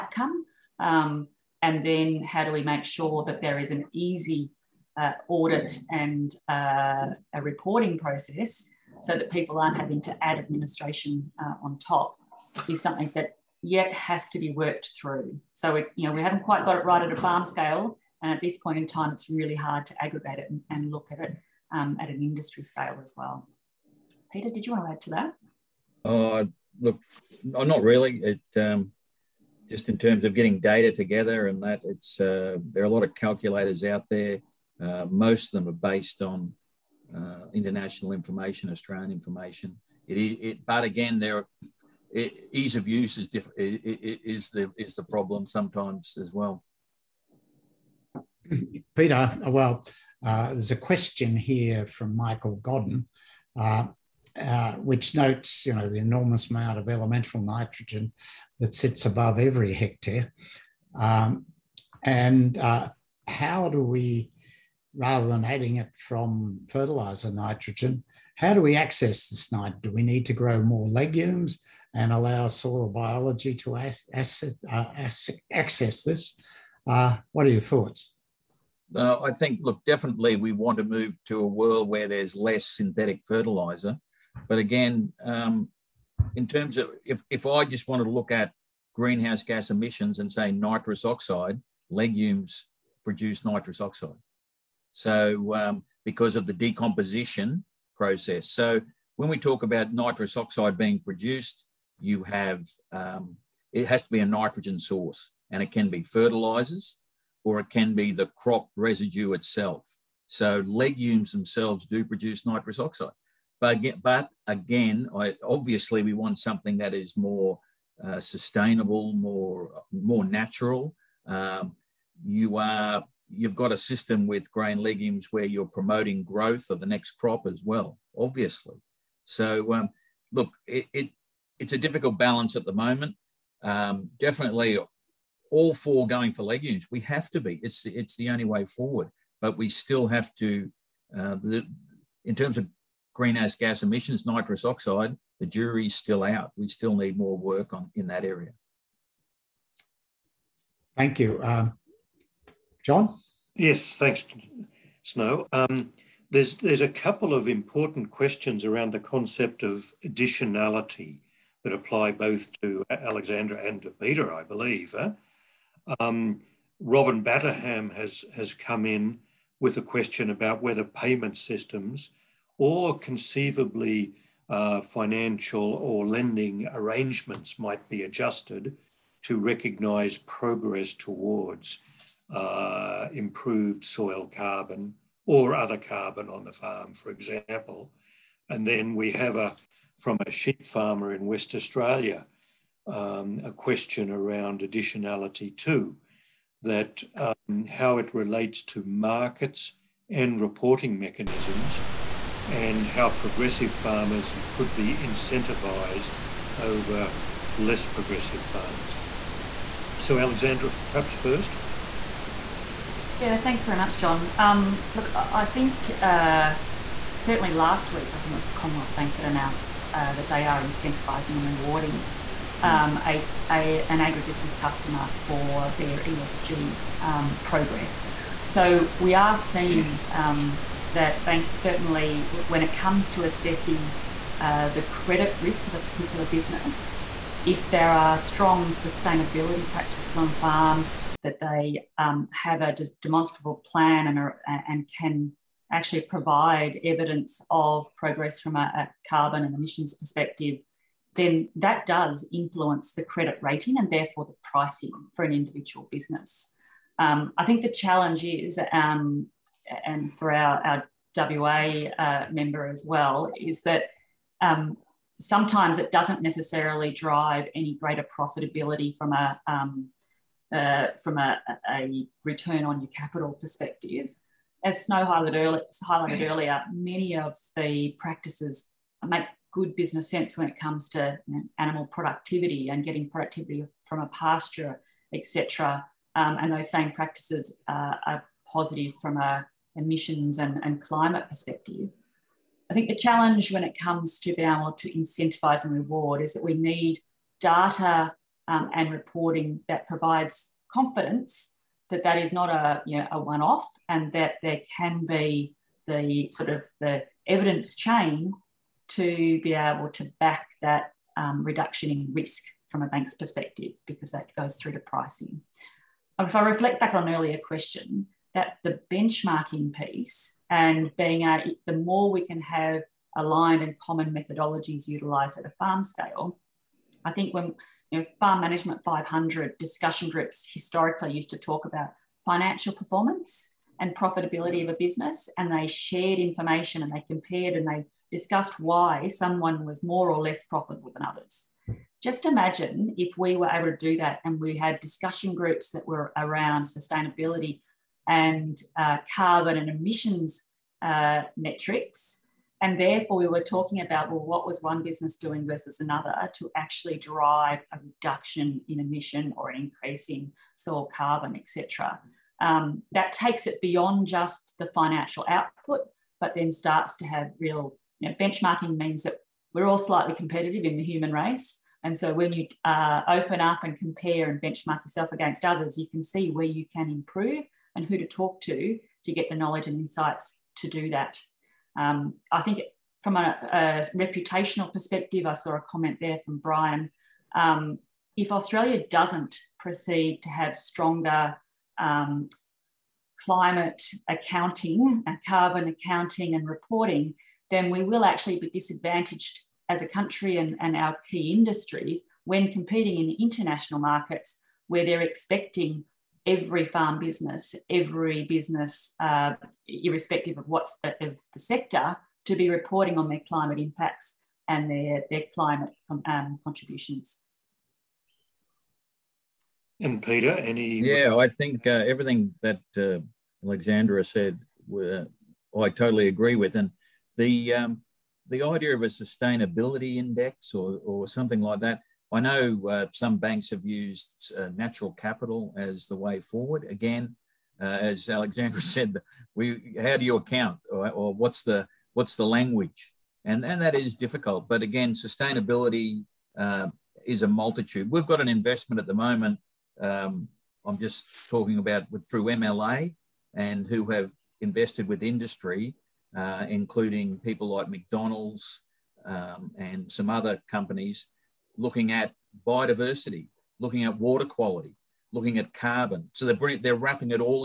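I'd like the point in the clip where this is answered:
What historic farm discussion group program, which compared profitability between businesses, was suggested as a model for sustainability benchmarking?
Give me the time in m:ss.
5:28.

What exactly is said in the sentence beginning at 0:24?
Peter, did you want to add to that?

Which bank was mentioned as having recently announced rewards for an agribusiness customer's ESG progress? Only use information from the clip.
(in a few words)
Commonwealth Bank.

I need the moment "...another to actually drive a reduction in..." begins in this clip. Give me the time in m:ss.
5:55.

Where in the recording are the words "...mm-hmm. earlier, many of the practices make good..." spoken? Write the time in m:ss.
4:36.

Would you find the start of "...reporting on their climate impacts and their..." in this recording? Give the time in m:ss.
6:52.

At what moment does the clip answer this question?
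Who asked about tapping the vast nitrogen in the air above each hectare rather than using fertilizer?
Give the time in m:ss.
0:52.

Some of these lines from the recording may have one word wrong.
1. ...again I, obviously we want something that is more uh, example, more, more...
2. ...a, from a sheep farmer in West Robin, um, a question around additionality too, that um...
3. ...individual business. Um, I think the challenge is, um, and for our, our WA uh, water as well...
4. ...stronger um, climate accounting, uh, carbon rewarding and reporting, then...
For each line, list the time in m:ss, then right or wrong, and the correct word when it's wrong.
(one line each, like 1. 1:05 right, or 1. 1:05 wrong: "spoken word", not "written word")
1. 1:54 wrong: "sustainable", not "example"
2. 3:09 wrong: "Australia", not "Robin"
3. 4:15 wrong: "member", not "water"
4. 6:30 wrong: "accounting", not "rewarding".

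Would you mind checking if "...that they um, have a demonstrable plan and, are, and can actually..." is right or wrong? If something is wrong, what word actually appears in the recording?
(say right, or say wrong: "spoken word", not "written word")
right.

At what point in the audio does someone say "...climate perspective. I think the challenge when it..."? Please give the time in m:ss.
4:50.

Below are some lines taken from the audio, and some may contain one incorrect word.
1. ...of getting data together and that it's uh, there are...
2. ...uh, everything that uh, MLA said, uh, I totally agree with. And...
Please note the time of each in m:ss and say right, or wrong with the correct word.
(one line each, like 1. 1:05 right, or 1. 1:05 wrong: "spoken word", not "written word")
1. 0:30 right
2. 7:01 wrong: "Alexandra", not "MLA".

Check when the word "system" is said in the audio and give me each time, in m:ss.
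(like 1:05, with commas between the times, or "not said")
2:03, 2:51.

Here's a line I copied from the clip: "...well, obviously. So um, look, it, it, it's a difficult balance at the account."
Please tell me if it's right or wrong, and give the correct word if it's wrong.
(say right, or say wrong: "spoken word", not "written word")
wrong: "moment", not "account".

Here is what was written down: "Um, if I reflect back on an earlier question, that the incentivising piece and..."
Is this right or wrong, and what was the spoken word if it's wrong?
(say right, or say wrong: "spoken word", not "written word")
wrong: "benchmarking", not "incentivising".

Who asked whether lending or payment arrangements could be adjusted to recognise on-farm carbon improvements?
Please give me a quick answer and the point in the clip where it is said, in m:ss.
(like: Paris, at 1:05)
Robin Batterham, at 2:46.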